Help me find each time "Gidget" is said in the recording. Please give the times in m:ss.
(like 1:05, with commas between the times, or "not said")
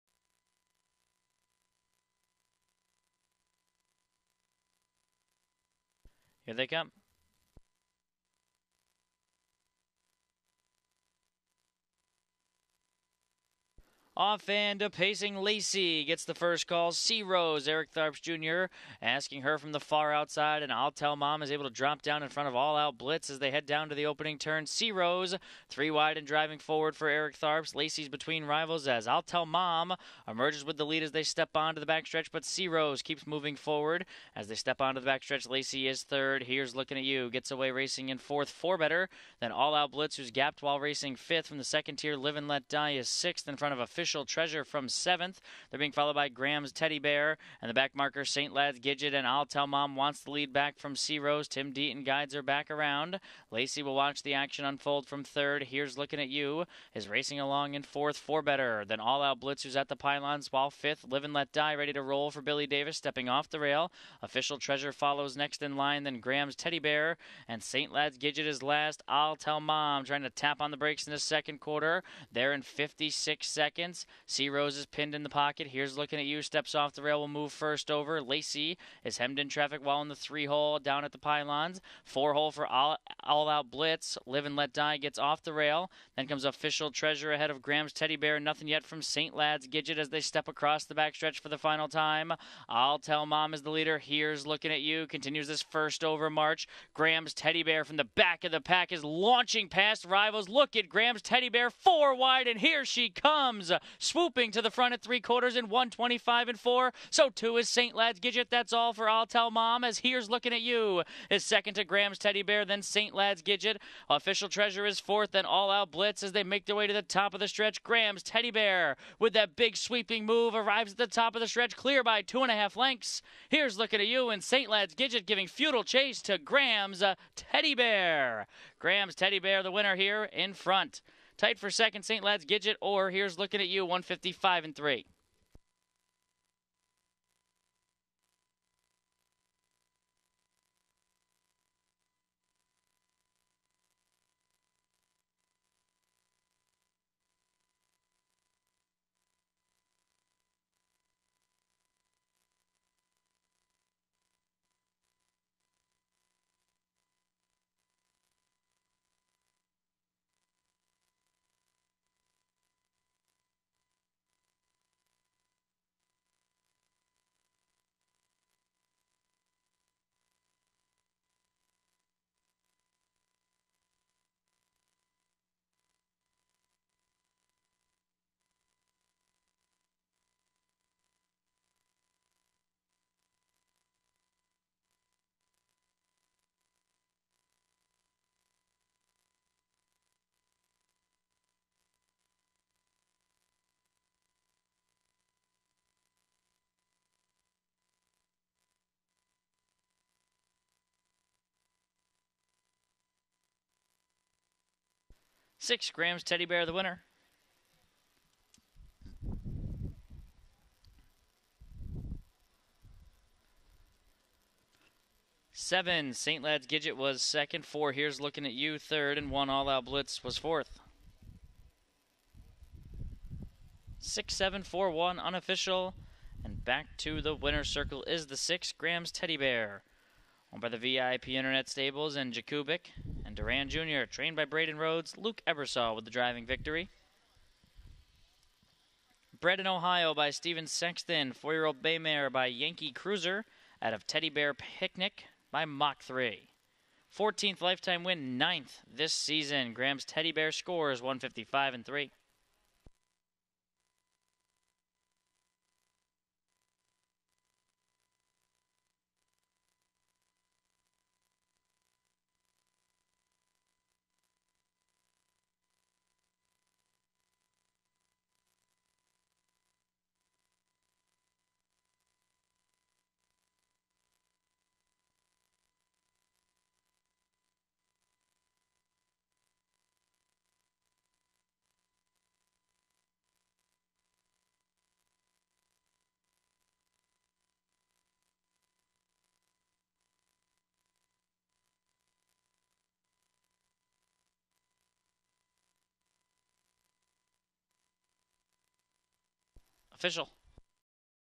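0:48, 1:08, 1:29, 1:48, 1:53, 2:04, 2:12, 3:36.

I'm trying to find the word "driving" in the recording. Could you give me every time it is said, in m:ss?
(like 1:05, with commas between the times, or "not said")
0:26, 3:56.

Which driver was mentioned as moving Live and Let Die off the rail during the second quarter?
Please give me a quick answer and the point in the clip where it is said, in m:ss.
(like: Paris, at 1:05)
Billy Davis, at 1:02.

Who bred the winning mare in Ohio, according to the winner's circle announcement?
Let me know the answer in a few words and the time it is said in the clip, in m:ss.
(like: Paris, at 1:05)
Steven Sexton, at 4:00.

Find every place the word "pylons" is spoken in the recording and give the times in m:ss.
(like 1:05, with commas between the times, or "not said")
0:59, 1:21.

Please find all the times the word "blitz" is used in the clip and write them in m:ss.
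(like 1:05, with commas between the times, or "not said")
0:22, 0:39, 0:59, 1:23, 1:55, 3:39.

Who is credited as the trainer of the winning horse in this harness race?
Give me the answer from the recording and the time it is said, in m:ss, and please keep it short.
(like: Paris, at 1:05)
Braden Rhodes, at 3:54.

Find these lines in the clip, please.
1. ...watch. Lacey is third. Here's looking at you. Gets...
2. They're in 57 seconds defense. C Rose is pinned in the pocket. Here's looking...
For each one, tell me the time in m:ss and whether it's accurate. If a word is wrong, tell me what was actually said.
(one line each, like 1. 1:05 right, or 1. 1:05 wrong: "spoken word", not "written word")
1. 0:35 wrong: "backstretch", not "watch"
2. 1:12 wrong: "56", not "57".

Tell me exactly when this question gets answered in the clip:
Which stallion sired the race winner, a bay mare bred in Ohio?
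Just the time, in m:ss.
4:02.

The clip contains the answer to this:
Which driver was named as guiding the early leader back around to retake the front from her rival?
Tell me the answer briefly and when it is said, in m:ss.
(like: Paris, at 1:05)
Tim Deaton, at 0:51.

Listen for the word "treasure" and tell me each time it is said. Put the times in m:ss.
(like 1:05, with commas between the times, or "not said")
0:44, 1:04, 1:26, 1:54.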